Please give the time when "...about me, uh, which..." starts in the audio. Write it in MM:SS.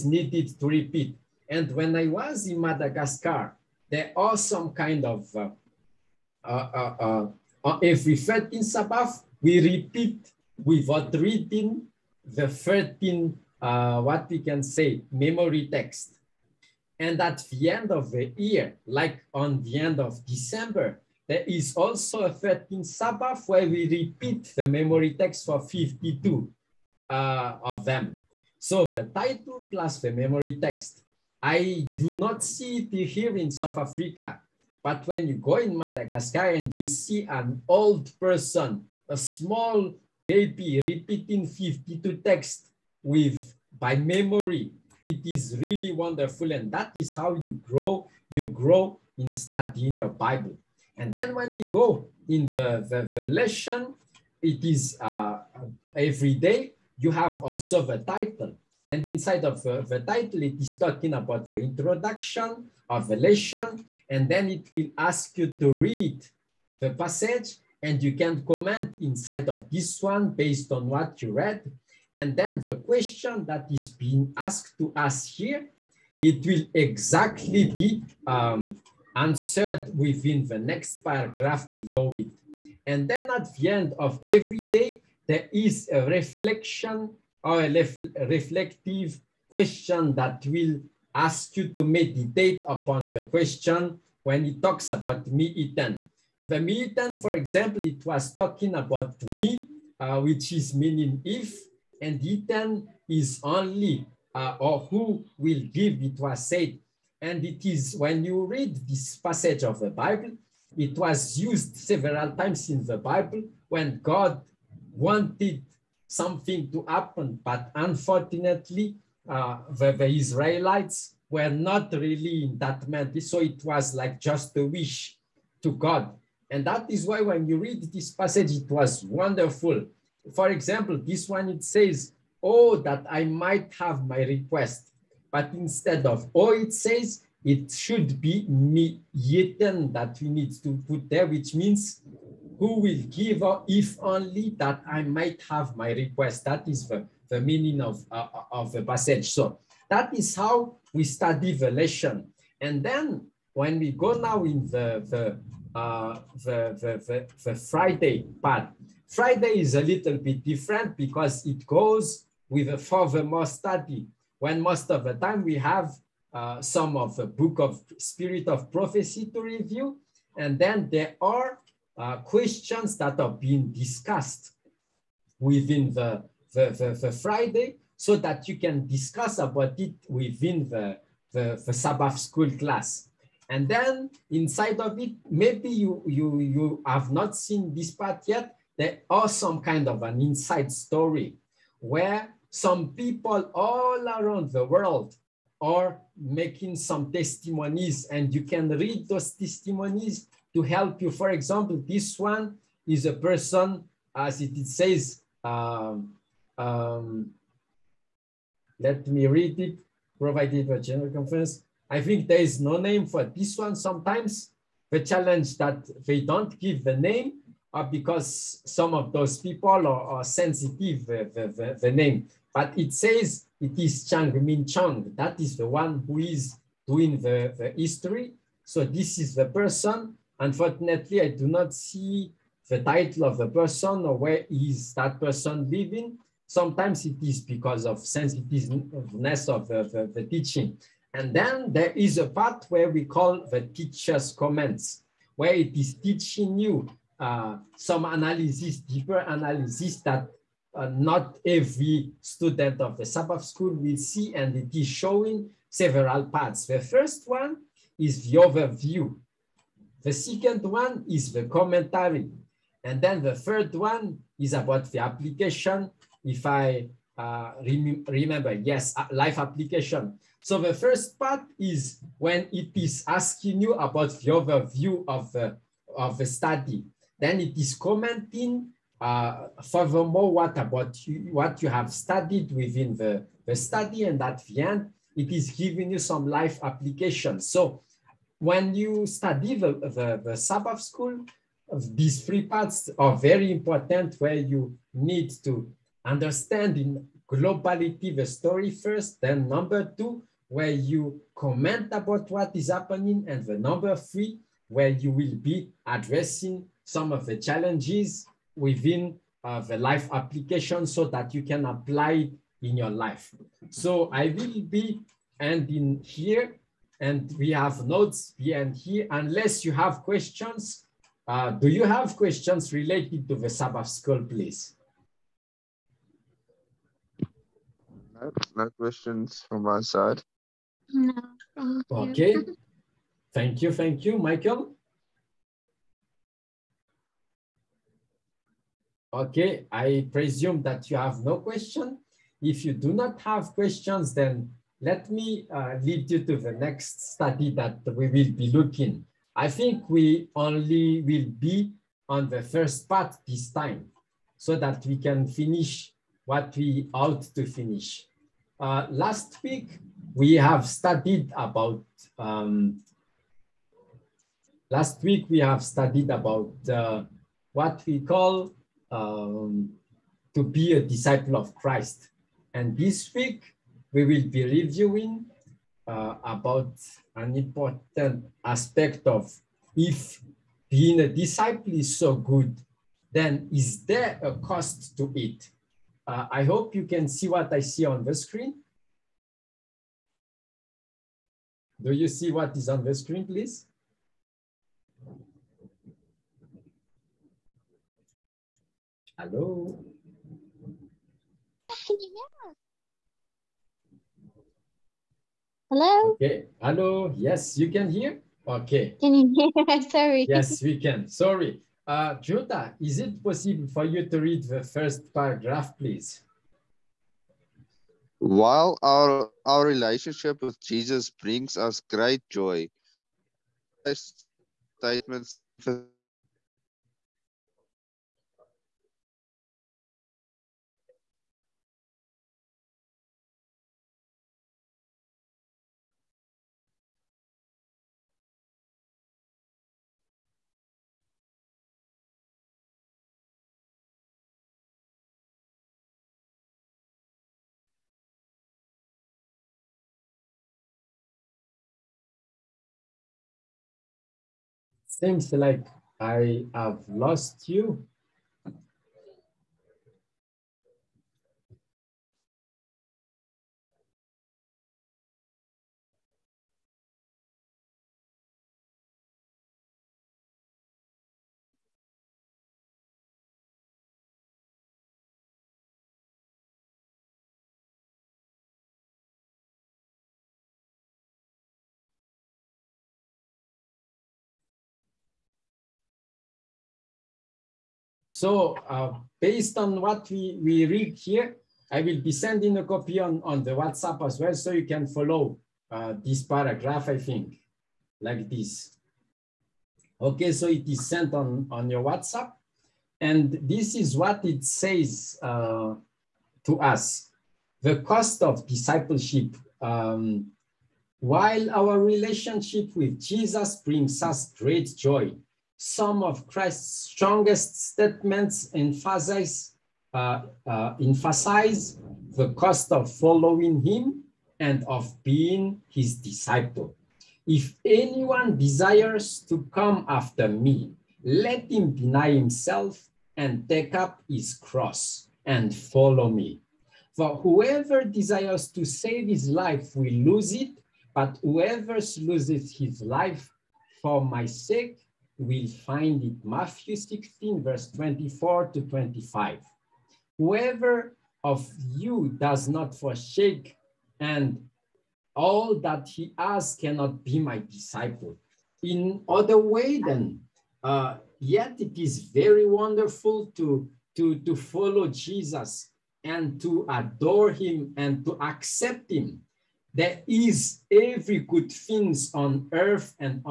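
01:38.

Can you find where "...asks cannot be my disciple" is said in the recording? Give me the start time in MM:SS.
09:16.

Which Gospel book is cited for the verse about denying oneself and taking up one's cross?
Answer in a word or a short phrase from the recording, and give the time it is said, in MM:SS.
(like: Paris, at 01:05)
Matthew, at 09:06.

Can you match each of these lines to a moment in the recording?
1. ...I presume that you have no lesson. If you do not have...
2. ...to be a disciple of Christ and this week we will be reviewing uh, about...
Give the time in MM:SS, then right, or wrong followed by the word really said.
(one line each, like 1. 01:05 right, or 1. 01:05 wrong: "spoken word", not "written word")
1. 05:39 wrong: "question", not "lesson"
2. 06:10 right.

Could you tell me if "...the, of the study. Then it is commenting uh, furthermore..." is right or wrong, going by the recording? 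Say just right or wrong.
right.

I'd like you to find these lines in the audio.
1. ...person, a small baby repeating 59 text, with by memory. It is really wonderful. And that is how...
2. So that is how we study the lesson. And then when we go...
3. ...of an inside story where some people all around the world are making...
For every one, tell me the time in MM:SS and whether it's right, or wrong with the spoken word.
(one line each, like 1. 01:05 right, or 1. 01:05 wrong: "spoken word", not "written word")
1. 00:38 wrong: "52", not "59"
2. 02:29 right
3. 03:09 right.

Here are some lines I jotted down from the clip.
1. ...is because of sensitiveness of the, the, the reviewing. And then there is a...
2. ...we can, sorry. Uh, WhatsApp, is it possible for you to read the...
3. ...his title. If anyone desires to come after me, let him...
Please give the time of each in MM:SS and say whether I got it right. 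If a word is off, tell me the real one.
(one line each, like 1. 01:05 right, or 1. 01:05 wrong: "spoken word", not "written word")
1. 03:57 wrong: "teaching", not "reviewing"
2. 06:50 wrong: "Jota", not "WhatsApp"
3. 08:45 wrong: "disciple", not "title".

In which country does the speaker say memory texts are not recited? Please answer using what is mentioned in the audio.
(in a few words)
South Africa.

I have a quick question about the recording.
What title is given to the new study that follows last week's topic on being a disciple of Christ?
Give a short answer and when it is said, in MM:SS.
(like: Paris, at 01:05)
The cost of discipleship, at 08:27.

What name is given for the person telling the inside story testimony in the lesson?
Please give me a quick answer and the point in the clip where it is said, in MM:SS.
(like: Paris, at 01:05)
Chang Min Chang, at 03:44.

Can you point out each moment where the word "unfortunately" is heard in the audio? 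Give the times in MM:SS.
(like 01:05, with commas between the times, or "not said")
01:57, 03:50.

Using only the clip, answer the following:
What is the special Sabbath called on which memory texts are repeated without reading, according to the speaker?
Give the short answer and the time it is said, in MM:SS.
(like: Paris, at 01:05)
13th Sabbath, at 00:22.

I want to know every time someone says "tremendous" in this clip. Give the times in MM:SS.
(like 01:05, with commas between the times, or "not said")
not said.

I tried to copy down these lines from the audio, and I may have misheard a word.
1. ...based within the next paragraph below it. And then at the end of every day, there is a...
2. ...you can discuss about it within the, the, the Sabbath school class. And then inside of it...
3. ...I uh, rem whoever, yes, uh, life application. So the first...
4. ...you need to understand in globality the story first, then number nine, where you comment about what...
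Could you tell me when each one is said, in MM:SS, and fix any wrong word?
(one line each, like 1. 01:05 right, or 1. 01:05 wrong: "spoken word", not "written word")
1. 01:19 wrong: "answered", not "based"
2. 02:58 right
3. 04:26 wrong: "remember", not "whoever"
4. 04:54 wrong: "two", not "nine".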